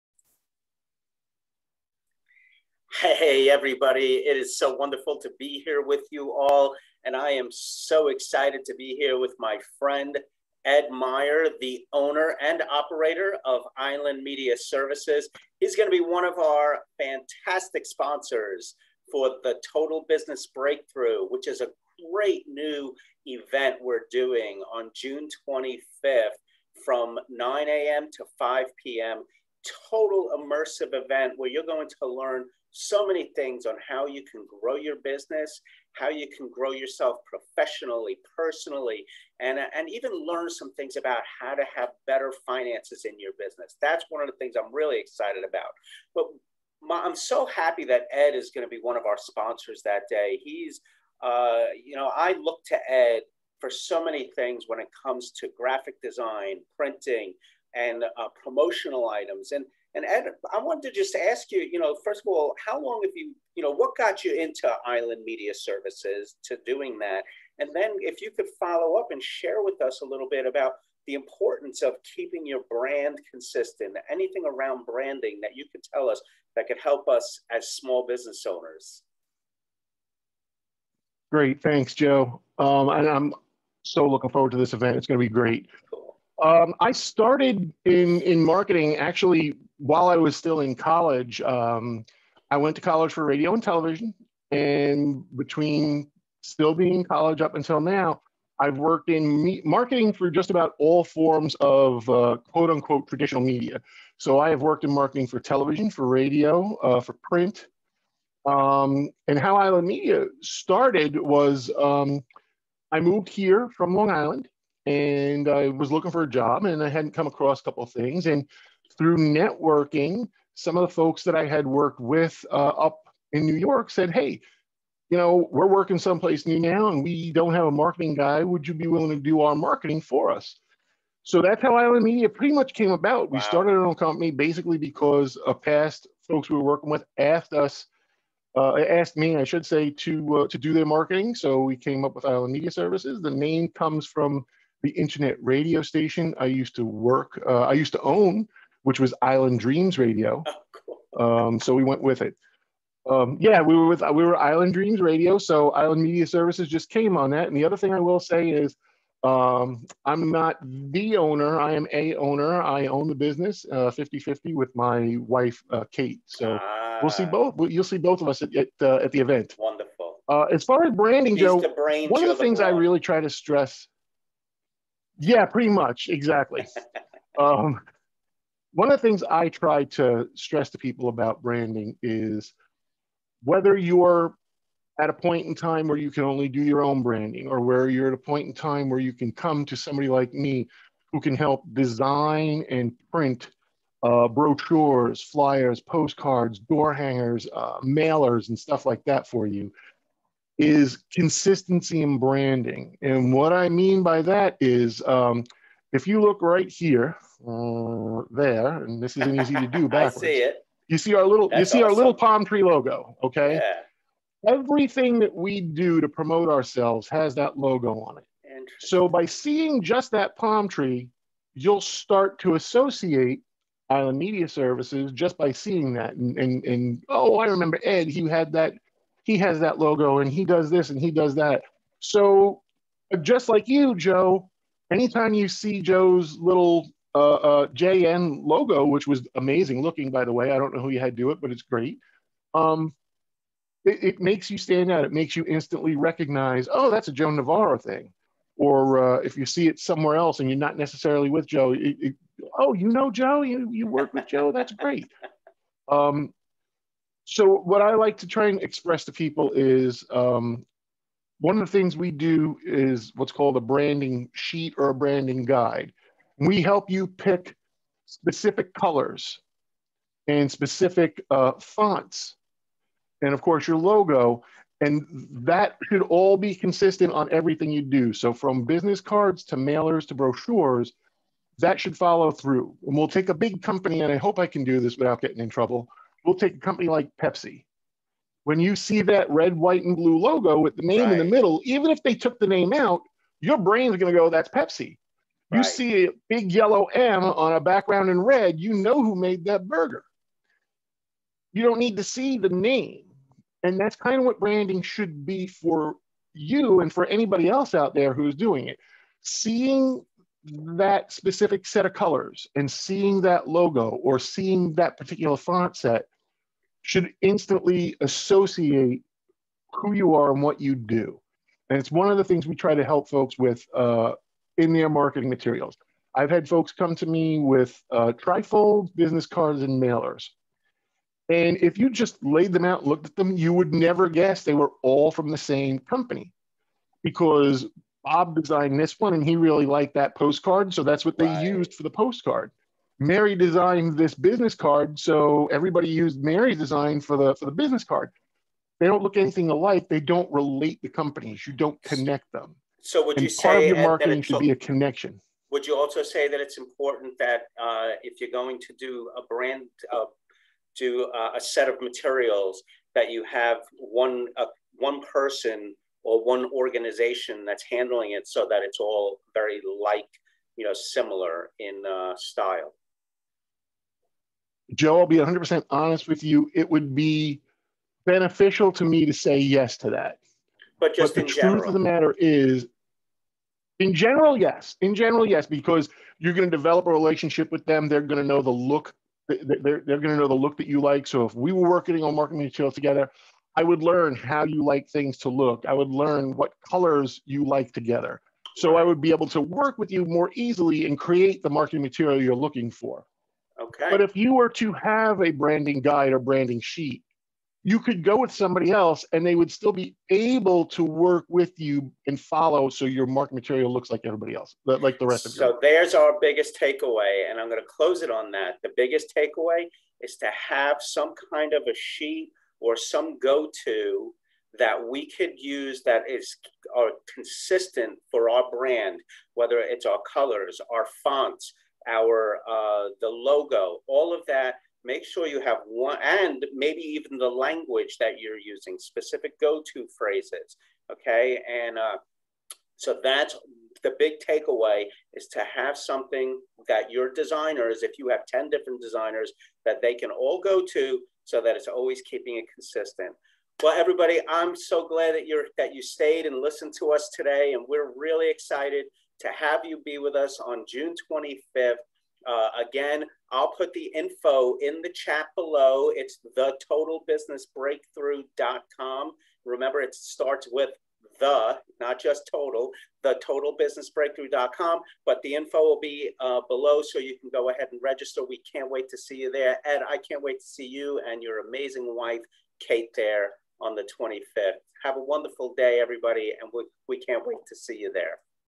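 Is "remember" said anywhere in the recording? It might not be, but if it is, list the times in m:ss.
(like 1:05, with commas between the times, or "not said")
3:47, 7:49.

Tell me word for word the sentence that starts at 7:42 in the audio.
Uh, again, I'll put the info in the chat below.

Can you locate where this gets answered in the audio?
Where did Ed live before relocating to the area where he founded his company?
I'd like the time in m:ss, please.
1:53.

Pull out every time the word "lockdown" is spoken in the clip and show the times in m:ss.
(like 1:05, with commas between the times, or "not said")
not said.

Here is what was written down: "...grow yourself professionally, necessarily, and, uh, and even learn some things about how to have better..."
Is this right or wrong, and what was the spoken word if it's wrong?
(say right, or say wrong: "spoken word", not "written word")
wrong: "personally", not "necessarily".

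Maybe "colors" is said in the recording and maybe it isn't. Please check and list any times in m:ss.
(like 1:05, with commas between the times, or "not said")
4:28, 5:11, 6:36, 7:10.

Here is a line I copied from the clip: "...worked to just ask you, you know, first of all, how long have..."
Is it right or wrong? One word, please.
wrong.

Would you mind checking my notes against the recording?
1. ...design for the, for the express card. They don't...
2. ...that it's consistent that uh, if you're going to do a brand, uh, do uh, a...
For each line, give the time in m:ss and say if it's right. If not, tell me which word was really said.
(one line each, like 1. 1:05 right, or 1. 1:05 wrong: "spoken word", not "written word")
1. 5:46 wrong: "business", not "express"
2. 5:56 wrong: "important", not "consistent".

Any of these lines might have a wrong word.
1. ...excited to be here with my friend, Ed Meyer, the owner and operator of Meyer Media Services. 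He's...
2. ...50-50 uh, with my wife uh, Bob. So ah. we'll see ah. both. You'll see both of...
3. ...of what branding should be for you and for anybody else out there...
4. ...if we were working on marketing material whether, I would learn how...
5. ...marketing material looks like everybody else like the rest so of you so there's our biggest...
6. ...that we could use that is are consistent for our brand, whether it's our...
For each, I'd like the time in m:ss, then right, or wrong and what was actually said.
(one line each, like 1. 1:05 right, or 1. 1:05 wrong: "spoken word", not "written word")
1. 0:08 wrong: "Island", not "Meyer"
2. 2:43 wrong: "Kate", not "Bob"
3. 5:04 right
4. 6:31 wrong: "together", not "whether"
5. 6:53 right
6. 7:04 right.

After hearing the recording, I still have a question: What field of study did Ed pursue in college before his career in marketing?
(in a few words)
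Radio and television.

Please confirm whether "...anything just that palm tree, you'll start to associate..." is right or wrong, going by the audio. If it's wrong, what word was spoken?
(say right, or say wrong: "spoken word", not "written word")
wrong: "seeing", not "anything".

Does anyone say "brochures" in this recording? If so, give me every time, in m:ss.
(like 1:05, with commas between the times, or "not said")
3:14, 4:40.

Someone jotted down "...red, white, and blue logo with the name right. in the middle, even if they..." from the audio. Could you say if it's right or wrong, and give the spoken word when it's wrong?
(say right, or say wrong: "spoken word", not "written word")
right.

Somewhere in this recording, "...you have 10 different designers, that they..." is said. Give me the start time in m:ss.
7:27.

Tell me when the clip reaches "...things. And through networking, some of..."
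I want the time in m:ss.
1:57.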